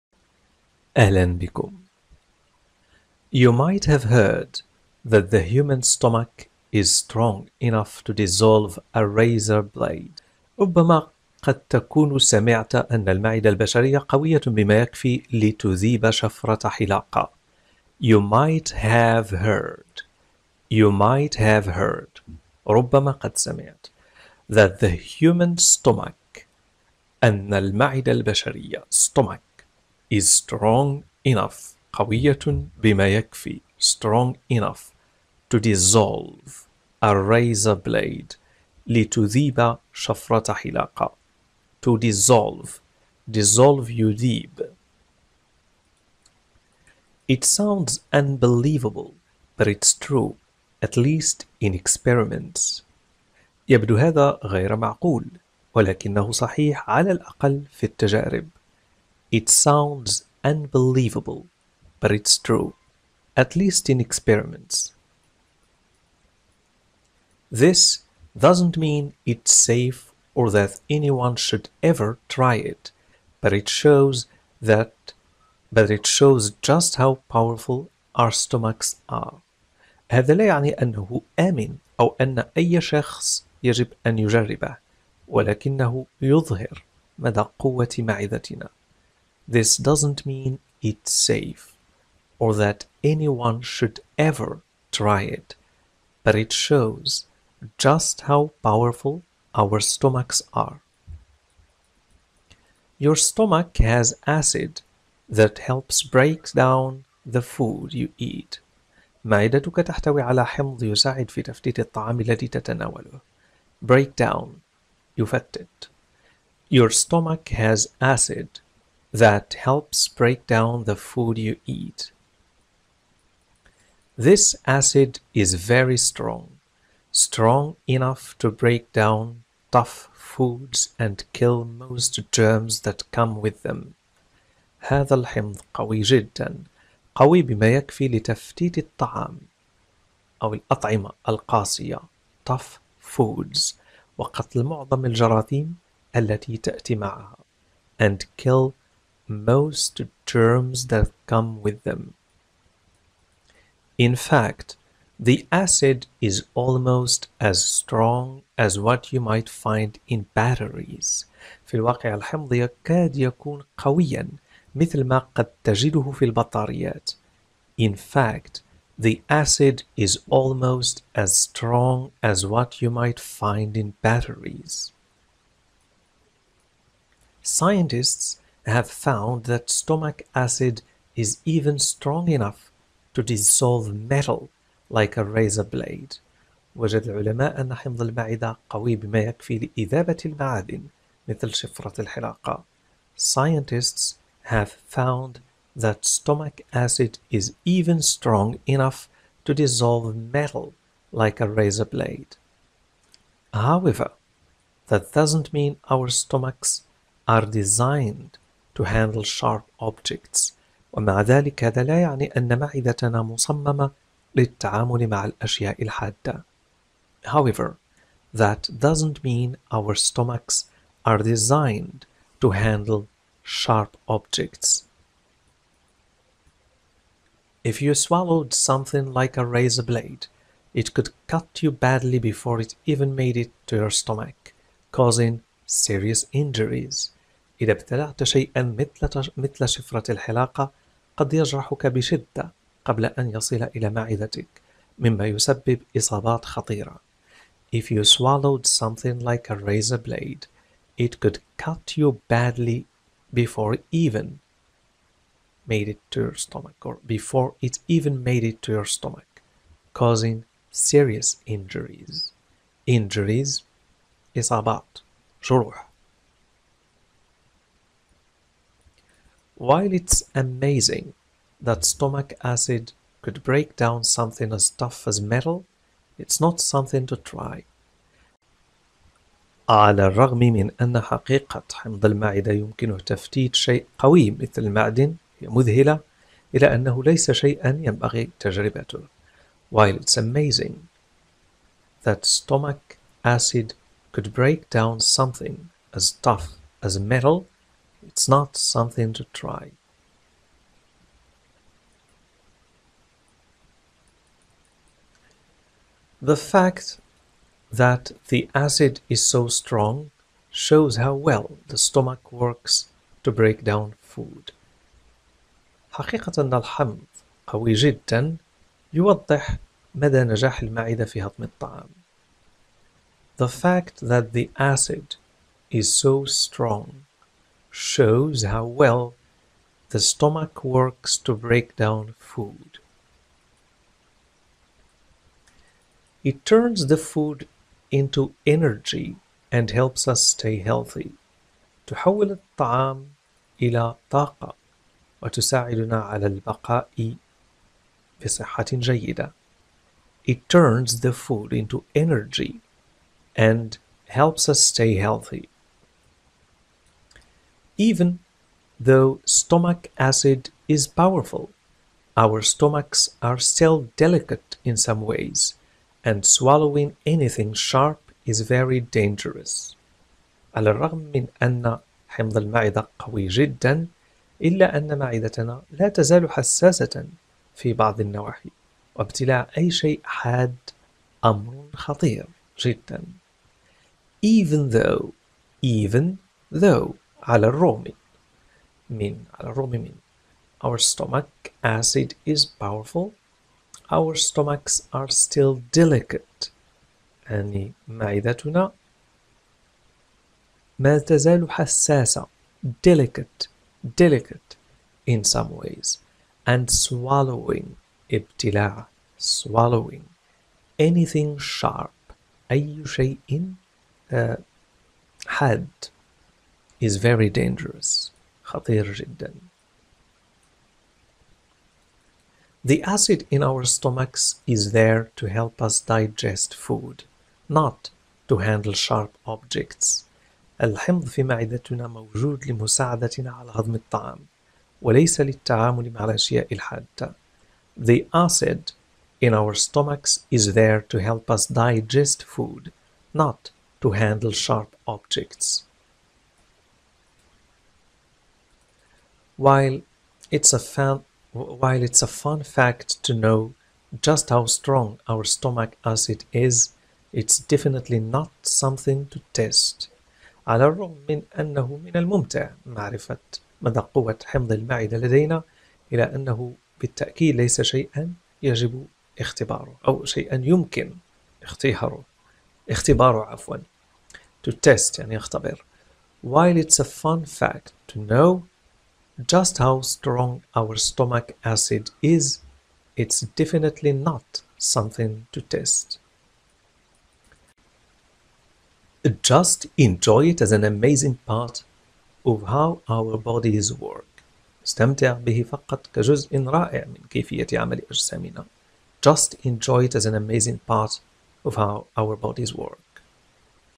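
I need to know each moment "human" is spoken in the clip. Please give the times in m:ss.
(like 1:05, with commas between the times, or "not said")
0:05, 0:24.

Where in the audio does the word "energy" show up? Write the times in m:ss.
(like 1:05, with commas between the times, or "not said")
5:38, 5:51.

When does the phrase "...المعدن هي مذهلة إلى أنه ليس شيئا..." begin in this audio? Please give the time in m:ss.
4:44.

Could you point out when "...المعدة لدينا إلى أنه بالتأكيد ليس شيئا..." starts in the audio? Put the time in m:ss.
7:44.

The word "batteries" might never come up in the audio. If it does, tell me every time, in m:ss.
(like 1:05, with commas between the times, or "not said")
2:40, 2:54.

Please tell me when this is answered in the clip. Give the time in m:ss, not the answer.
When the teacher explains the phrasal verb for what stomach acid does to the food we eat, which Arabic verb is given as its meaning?
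1:55.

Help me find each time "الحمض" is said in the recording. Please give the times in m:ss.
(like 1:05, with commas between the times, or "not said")
2:15, 2:42, 5:16, 7:10.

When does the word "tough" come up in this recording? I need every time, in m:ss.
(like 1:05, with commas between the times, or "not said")
2:09, 2:22, 4:34, 4:56.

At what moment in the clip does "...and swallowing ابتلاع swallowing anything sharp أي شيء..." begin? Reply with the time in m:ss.
6:46.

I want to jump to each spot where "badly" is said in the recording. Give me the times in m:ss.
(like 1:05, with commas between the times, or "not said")
3:51, 4:12.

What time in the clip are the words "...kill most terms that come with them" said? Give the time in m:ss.
2:28.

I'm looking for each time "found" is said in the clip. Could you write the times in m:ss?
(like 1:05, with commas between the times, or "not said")
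2:58, 3:14.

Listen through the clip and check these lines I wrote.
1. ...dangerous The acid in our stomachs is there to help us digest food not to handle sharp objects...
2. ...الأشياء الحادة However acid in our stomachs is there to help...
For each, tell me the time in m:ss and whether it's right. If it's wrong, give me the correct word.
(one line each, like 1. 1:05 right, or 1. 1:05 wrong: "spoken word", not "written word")
1. 6:57 right
2. 7:16 wrong: "The", not "However".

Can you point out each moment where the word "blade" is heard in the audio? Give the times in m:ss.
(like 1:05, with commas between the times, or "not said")
0:09, 0:37, 3:05, 3:21, 3:49, 4:09.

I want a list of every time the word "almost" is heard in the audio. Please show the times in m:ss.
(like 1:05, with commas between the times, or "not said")
2:36, 2:50.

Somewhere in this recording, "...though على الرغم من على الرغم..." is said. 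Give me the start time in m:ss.
6:26.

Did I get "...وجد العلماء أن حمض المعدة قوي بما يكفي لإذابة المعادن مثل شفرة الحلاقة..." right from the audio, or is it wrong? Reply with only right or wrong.
right.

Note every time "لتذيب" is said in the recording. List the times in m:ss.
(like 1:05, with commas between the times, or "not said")
0:15, 0:38.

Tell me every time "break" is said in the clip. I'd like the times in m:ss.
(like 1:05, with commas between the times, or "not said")
1:46, 1:53, 2:00, 2:08, 4:33, 4:54, 5:13, 5:31.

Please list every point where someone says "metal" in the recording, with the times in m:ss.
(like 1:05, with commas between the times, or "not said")
3:03, 3:20, 4:35, 4:56.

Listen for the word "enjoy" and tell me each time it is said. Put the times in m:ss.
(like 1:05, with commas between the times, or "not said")
8:09, 8:19.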